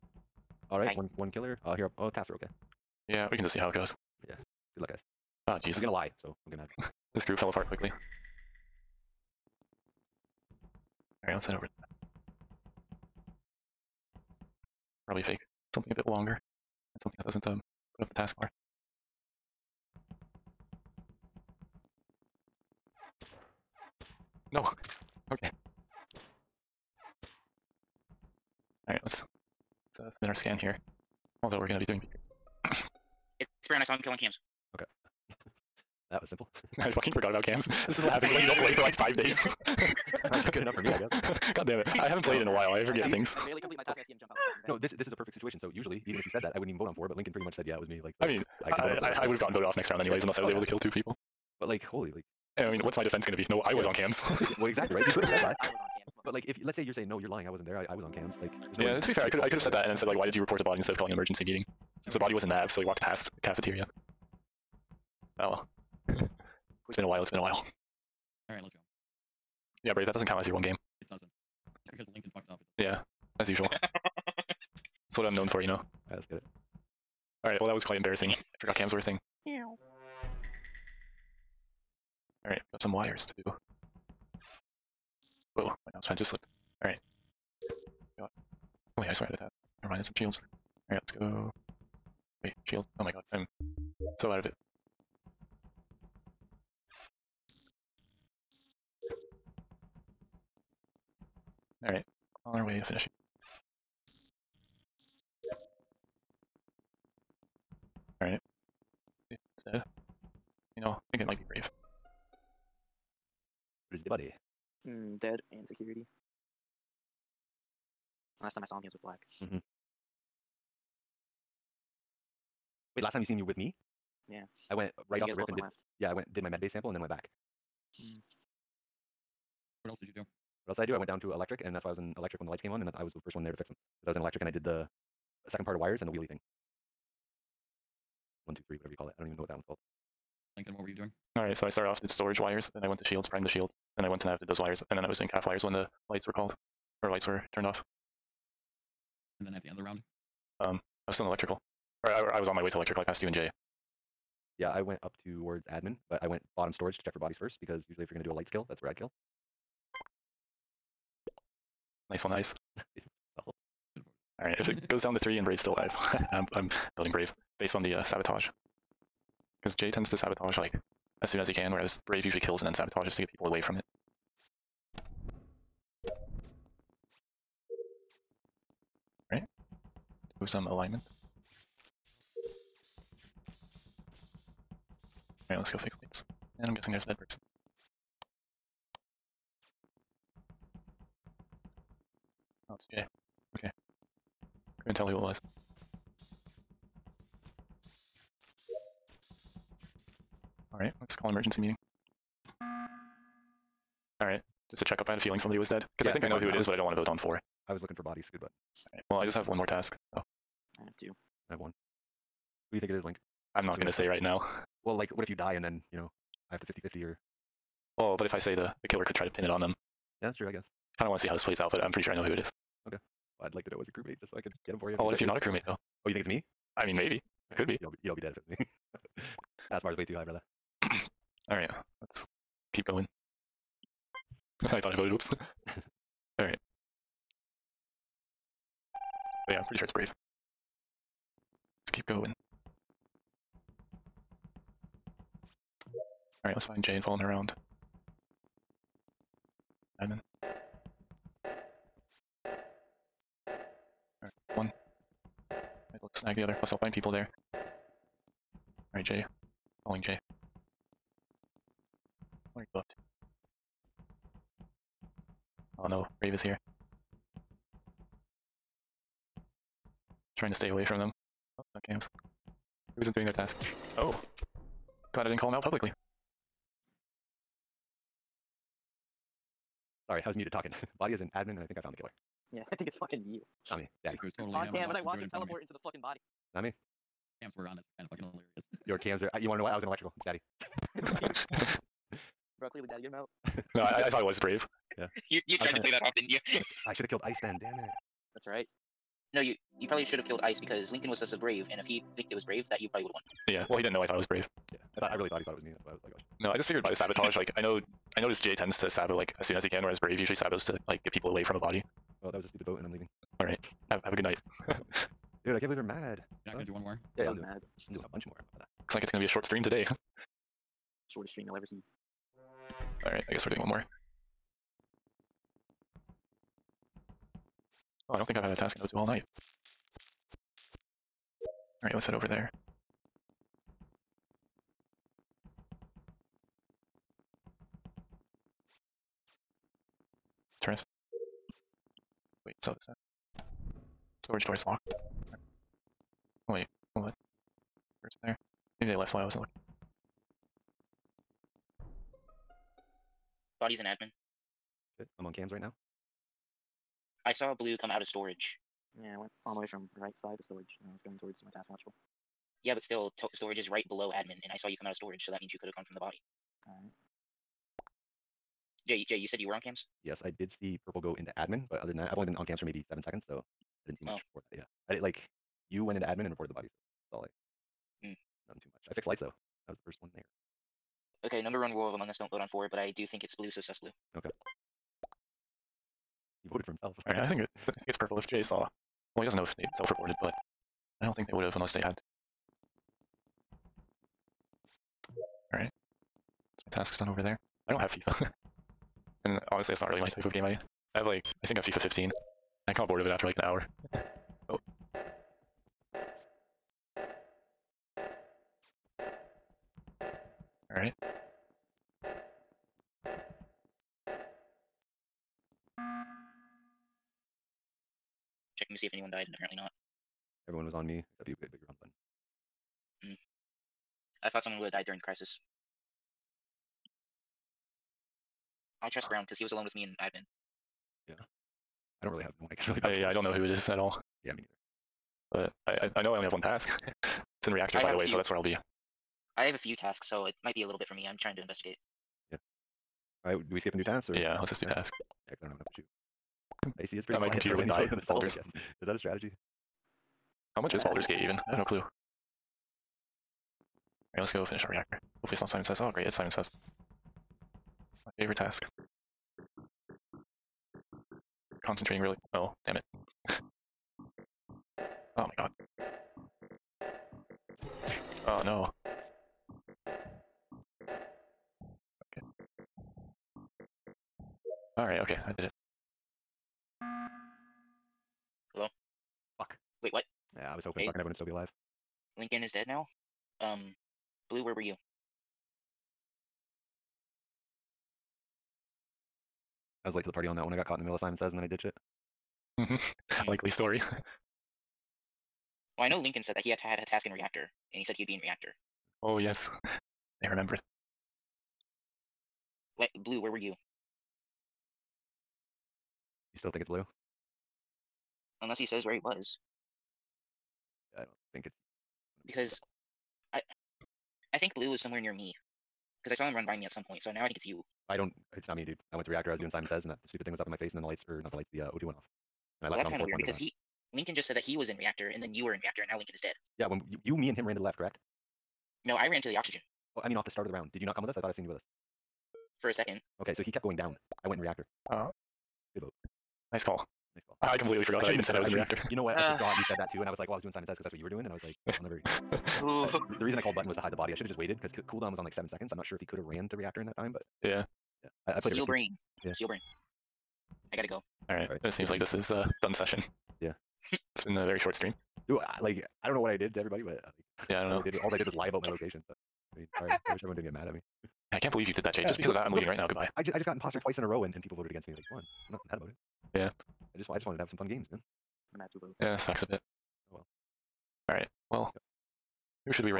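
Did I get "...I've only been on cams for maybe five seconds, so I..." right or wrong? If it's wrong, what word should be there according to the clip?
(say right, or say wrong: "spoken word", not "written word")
wrong: "seven", not "five".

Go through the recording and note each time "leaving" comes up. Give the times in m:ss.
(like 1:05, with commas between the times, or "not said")
5:12, 9:22.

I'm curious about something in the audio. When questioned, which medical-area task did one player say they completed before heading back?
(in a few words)
med base sample.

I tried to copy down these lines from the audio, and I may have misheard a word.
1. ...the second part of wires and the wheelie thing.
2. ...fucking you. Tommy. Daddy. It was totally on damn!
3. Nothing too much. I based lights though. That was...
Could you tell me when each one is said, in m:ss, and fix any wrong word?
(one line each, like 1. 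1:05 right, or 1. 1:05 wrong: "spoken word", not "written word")
1. 2:14 right
2. 4:42 right
3. 6:18 wrong: "fixed", not "based".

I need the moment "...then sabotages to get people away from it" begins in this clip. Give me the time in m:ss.
2:52.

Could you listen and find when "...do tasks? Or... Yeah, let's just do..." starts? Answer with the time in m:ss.
7:23.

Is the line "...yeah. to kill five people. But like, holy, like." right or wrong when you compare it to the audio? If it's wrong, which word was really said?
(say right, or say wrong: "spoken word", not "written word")
wrong: "two", not "five".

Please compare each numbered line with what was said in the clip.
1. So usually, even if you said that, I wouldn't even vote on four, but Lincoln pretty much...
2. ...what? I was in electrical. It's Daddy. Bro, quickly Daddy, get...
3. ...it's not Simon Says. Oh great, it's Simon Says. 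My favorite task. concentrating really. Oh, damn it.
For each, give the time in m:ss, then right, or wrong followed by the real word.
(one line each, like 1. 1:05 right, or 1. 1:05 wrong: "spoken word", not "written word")
1. 0:45 right
2. 4:49 wrong: "clearly", not "quickly"
3. 7:35 right.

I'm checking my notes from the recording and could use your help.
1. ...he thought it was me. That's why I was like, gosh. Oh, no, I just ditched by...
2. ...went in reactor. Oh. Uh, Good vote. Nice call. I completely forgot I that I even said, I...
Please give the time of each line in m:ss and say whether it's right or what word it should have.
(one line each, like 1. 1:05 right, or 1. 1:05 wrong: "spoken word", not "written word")
1. 5:05 wrong: "figured", not "ditched"
2. 8:54 right.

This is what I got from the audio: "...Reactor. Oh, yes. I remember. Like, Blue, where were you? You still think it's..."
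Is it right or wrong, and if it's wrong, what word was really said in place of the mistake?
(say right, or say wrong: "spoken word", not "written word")
right.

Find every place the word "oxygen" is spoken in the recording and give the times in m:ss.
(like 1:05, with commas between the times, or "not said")
8:49.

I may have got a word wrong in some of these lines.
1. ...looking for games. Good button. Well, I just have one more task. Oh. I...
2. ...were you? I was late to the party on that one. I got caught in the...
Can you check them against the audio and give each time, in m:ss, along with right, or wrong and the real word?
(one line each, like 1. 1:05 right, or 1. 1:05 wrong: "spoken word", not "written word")
1. 3:27 wrong: "bodies", not "games"
2. 8:04 right.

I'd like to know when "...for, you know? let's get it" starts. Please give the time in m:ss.
1:15.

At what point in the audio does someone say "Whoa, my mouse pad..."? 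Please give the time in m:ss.
1:25.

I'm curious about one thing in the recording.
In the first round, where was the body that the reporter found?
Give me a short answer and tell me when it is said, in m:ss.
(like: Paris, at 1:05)
nav, at 1:02.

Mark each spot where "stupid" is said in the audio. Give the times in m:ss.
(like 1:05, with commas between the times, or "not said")
5:12, 8:40.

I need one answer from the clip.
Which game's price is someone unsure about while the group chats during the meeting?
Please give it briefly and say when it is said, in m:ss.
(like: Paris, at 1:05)
Baldur's Gate, at 7:30.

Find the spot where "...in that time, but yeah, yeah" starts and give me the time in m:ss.
9:06.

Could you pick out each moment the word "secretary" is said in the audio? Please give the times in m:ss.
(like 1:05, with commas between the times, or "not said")
not said.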